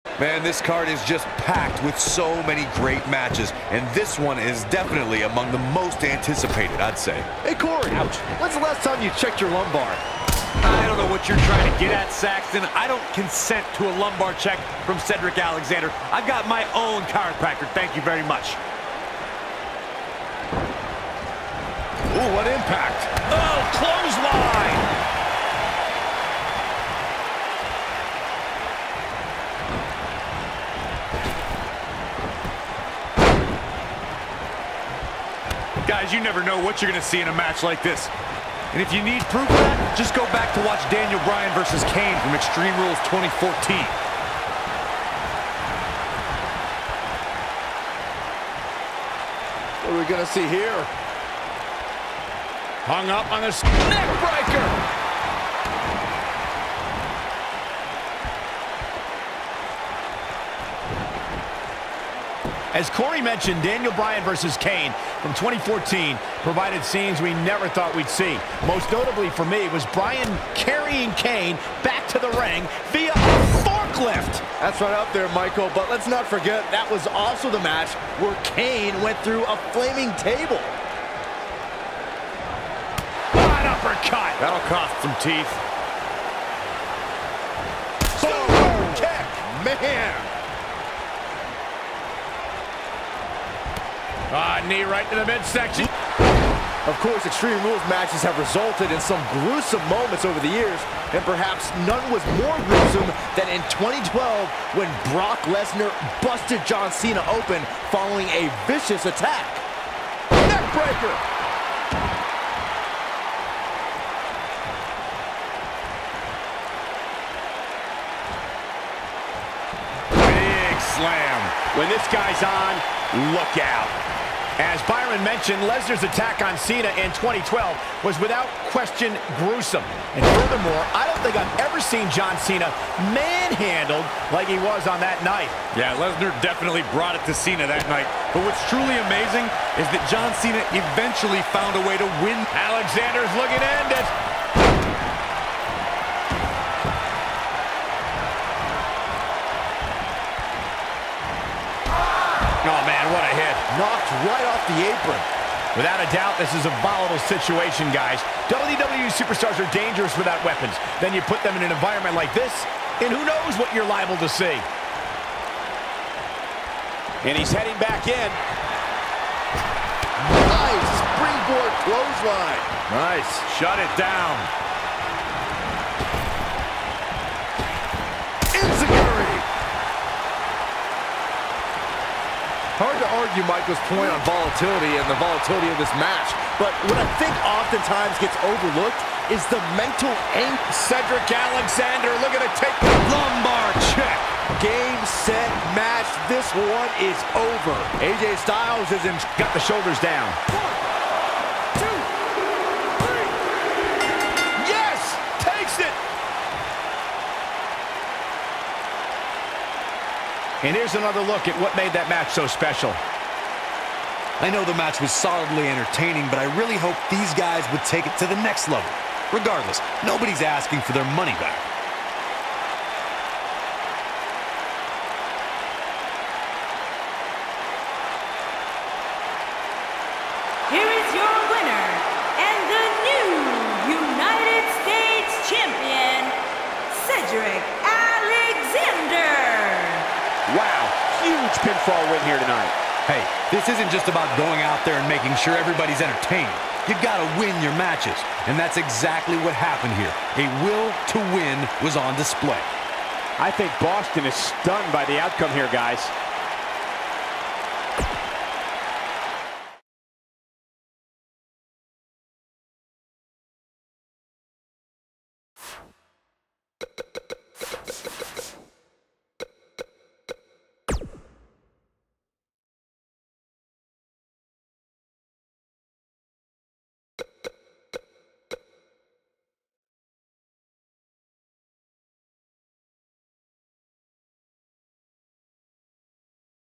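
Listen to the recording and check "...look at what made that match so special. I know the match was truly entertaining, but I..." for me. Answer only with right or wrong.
wrong.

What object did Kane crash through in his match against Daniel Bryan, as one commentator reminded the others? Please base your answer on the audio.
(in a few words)
Flaming table.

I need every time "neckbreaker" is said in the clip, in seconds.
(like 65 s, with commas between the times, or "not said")
53 s, 110 s.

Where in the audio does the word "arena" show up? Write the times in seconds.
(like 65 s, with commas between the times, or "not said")
not said.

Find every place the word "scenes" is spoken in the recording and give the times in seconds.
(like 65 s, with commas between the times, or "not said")
66 s.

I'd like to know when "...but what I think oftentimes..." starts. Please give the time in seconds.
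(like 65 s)
186 s.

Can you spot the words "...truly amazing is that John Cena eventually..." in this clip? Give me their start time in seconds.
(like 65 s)
138 s.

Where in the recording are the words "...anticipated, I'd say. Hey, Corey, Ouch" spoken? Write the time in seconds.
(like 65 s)
6 s.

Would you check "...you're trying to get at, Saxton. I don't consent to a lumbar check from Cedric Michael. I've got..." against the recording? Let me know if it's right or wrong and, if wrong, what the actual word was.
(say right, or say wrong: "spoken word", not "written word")
wrong: "Alexander", not "Michael".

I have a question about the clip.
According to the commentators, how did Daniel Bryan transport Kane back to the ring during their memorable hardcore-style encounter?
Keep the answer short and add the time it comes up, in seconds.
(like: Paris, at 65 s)
Via forklift, at 72 s.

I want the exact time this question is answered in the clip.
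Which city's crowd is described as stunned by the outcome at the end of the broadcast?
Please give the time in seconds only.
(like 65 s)
253 s.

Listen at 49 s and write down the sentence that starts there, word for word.
What are we going to see here?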